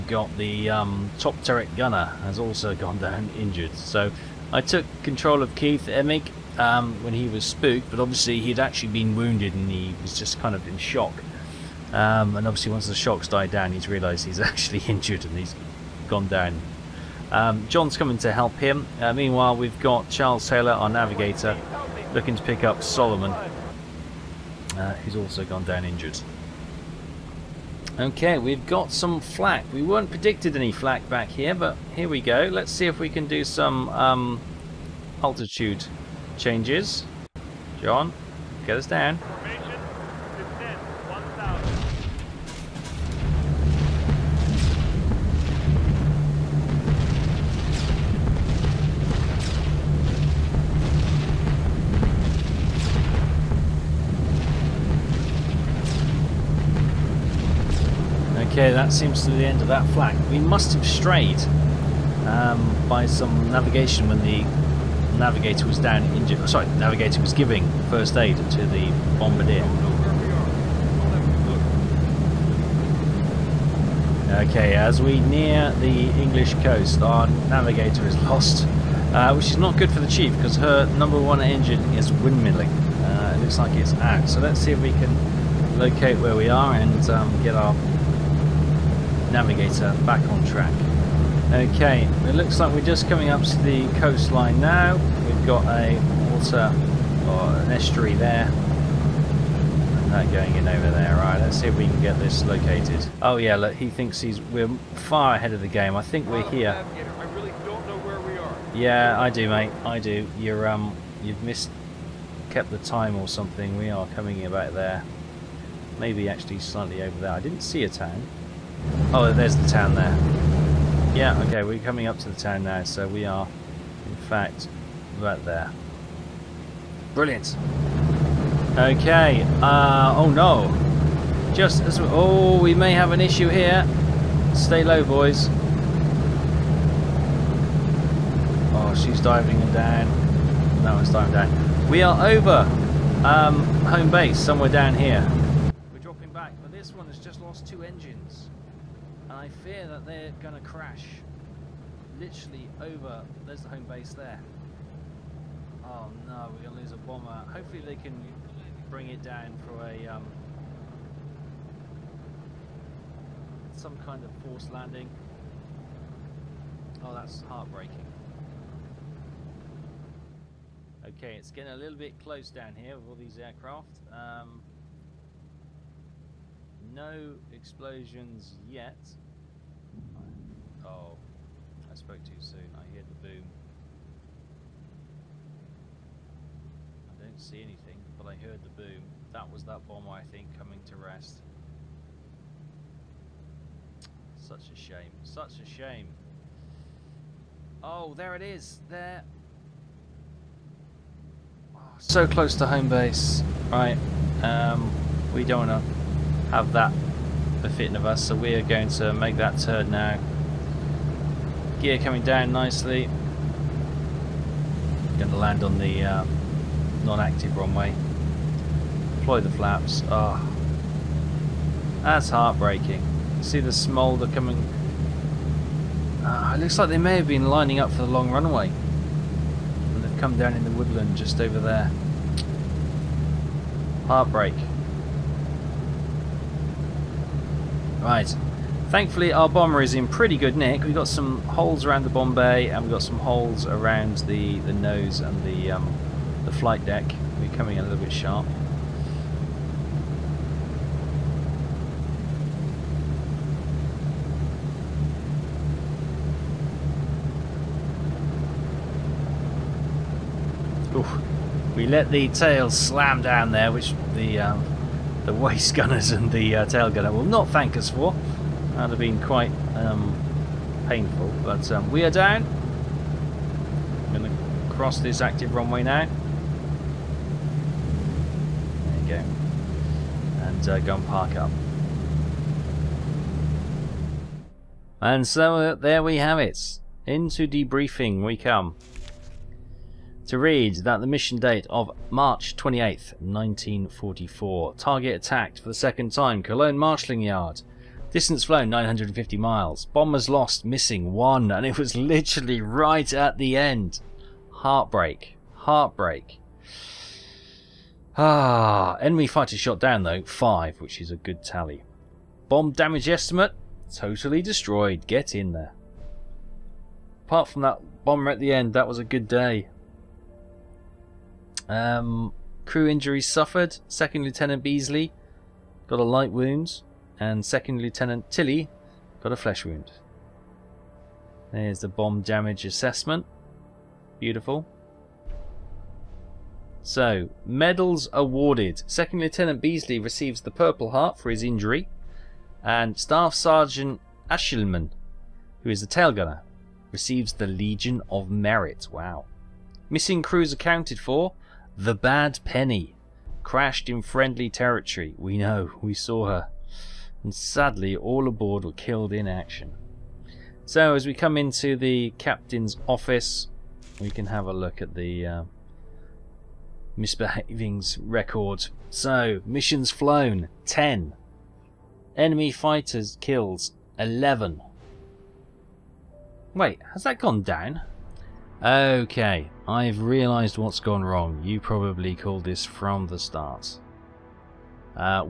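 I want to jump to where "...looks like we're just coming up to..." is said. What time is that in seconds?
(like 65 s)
92 s.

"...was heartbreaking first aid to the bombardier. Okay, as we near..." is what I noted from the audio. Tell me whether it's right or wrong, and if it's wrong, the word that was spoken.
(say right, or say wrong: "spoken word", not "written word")
wrong: "giving", not "heartbreaking".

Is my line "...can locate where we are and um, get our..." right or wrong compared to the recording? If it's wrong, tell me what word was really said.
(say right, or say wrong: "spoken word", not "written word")
right.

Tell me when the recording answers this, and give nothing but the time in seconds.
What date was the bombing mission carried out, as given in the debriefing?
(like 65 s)
292 s.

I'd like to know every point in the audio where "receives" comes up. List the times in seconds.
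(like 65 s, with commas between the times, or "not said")
340 s, 346 s.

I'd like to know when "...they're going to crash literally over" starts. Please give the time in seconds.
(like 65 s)
150 s.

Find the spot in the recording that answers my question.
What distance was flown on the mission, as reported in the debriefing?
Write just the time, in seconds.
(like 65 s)
298 s.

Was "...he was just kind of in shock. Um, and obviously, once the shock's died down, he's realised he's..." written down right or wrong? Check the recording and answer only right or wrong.
right.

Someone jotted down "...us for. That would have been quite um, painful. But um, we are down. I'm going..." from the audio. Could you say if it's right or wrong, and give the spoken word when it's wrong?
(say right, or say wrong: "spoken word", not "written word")
right.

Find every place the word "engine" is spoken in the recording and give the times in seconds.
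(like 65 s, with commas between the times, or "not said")
81 s, 147 s.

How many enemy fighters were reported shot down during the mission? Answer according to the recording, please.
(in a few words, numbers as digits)
5.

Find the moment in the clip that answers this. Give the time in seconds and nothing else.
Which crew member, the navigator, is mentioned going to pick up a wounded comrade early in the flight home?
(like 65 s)
20 s.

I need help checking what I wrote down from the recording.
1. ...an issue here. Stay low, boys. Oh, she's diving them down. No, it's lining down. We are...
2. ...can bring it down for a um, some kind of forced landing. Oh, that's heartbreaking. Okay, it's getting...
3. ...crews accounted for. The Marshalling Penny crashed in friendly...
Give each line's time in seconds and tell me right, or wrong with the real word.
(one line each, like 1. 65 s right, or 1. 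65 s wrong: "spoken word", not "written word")
1. 133 s wrong: "diving", not "lining"
2. 157 s right
3. 350 s wrong: "Bad", not "Marshalling".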